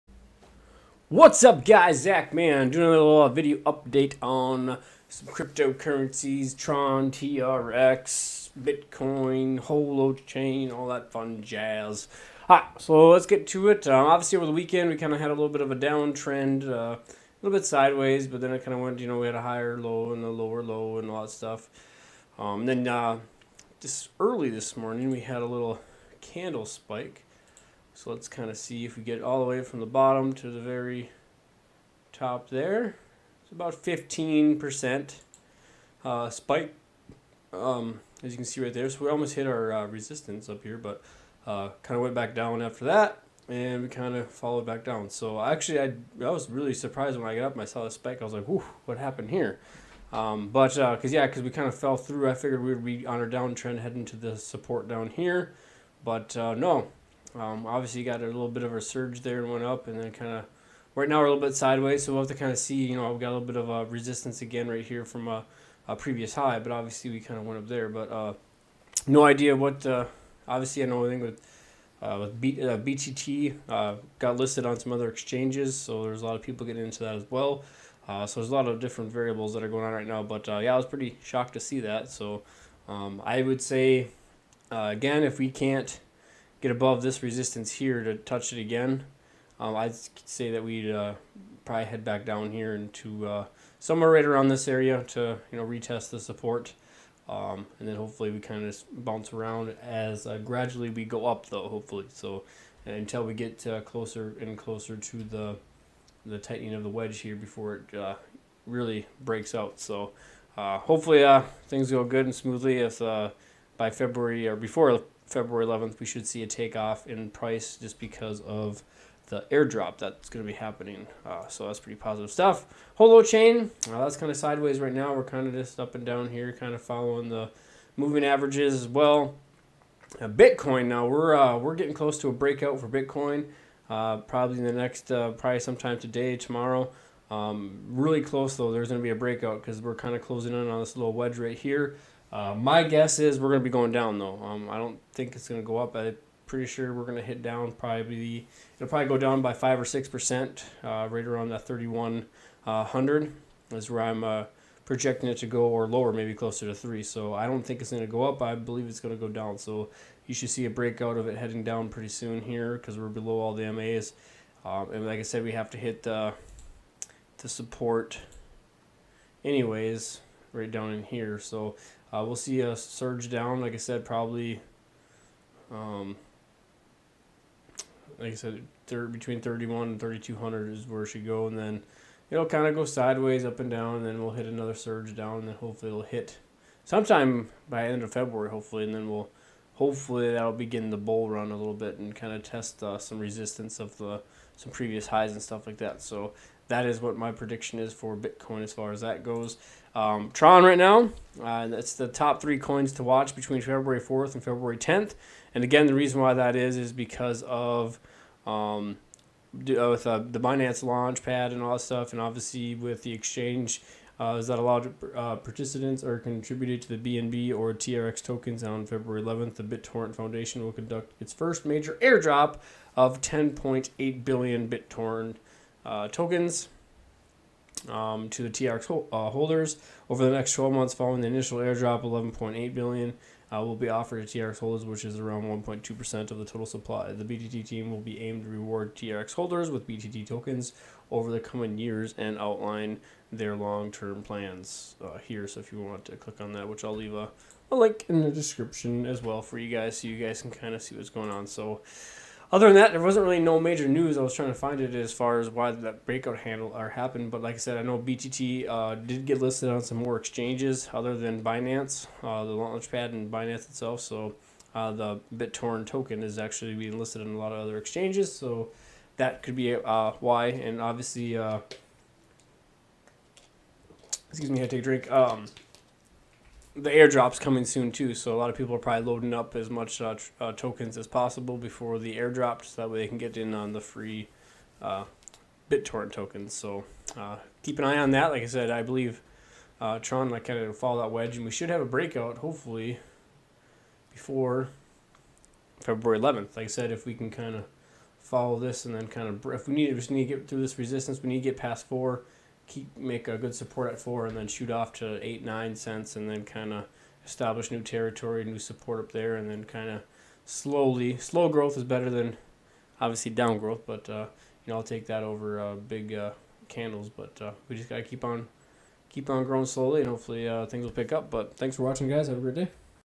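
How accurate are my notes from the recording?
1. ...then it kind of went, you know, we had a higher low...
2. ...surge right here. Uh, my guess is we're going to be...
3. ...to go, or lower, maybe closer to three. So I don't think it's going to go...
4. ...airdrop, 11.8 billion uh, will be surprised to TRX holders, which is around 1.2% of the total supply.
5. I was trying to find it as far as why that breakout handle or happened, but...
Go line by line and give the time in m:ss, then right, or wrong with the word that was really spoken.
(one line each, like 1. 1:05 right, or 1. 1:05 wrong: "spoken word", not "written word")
1. 0:18 right
2. 2:21 wrong: "wedge", not "surge"
3. 2:35 right
4. 3:51 wrong: "offered", not "surprised"
5. 4:14 right.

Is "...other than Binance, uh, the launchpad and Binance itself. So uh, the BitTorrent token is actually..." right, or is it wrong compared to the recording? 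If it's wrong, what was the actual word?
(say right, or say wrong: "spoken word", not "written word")
right.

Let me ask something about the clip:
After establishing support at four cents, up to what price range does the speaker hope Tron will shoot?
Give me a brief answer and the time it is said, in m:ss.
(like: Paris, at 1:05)
8-9 cents, at 5:05.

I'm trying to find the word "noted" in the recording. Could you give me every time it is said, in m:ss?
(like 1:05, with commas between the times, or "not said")
not said.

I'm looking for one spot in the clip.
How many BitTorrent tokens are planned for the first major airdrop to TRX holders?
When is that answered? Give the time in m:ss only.
3:43.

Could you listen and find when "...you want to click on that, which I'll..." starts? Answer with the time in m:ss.
4:05.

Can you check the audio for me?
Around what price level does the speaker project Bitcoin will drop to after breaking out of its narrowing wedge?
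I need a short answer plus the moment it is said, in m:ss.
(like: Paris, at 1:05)
3100, at 2:31.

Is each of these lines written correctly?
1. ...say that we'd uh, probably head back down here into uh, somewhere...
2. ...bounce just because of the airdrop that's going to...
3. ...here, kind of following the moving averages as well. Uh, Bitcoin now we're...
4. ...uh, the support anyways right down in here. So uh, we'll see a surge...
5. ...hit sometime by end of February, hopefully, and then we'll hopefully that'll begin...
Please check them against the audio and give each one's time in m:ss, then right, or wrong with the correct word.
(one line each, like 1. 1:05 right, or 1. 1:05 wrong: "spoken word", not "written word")
1. 1:30 right
2. 1:57 wrong: "price", not "bounce"
3. 2:06 right
4. 2:46 right
5. 3:06 right.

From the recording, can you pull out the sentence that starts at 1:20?
But uh, yeah, I was pretty shocked to see that.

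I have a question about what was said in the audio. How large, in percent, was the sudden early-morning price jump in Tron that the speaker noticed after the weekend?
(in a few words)
15%.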